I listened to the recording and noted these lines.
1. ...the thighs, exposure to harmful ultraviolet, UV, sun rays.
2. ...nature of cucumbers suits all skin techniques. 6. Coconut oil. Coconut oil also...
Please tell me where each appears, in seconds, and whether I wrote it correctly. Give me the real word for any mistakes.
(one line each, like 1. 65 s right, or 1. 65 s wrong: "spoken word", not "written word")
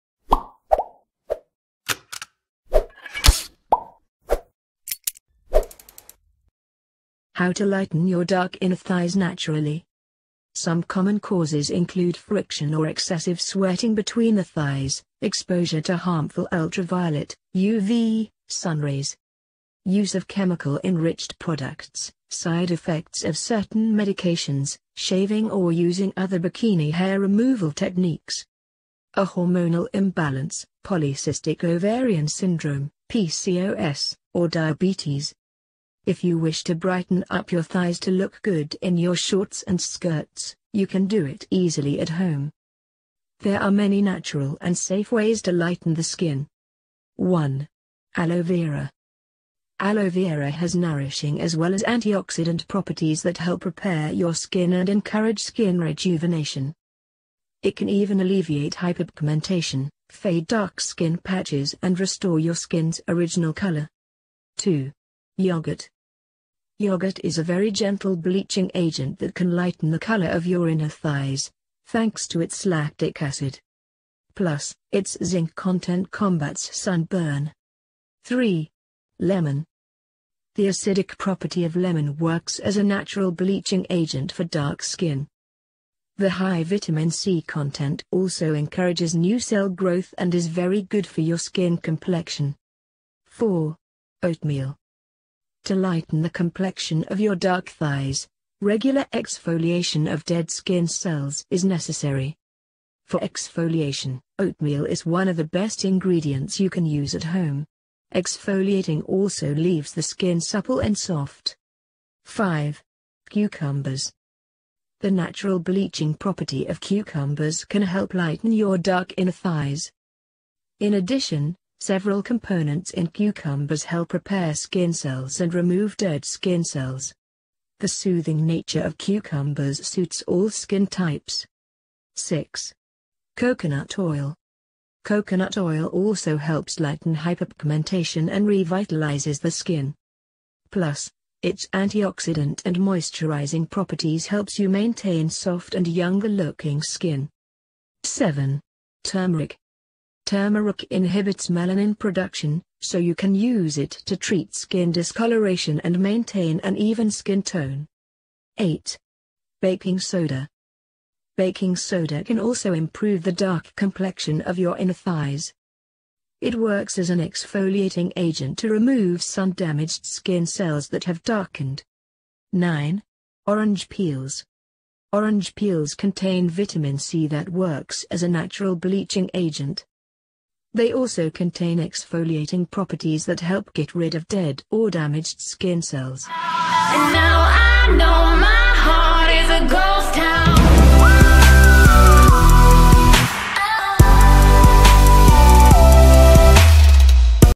1. 14 s right
2. 128 s wrong: "types", not "techniques".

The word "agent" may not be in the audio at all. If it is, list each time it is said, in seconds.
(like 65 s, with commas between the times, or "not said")
68 s, 83 s, 168 s, 179 s.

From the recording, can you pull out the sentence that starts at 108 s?
Exfoliating also leaves the skin supple and soft.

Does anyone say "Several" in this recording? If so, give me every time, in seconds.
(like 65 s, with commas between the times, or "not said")
121 s.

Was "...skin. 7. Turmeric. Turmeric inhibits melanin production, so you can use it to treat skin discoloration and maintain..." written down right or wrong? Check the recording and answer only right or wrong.
right.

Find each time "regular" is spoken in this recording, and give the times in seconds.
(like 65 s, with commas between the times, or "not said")
98 s.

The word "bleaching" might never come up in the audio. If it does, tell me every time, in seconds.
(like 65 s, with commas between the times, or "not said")
68 s, 83 s, 115 s, 178 s.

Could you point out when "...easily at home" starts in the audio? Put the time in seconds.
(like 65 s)
41 s.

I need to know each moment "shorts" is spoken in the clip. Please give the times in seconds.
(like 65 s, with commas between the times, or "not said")
39 s.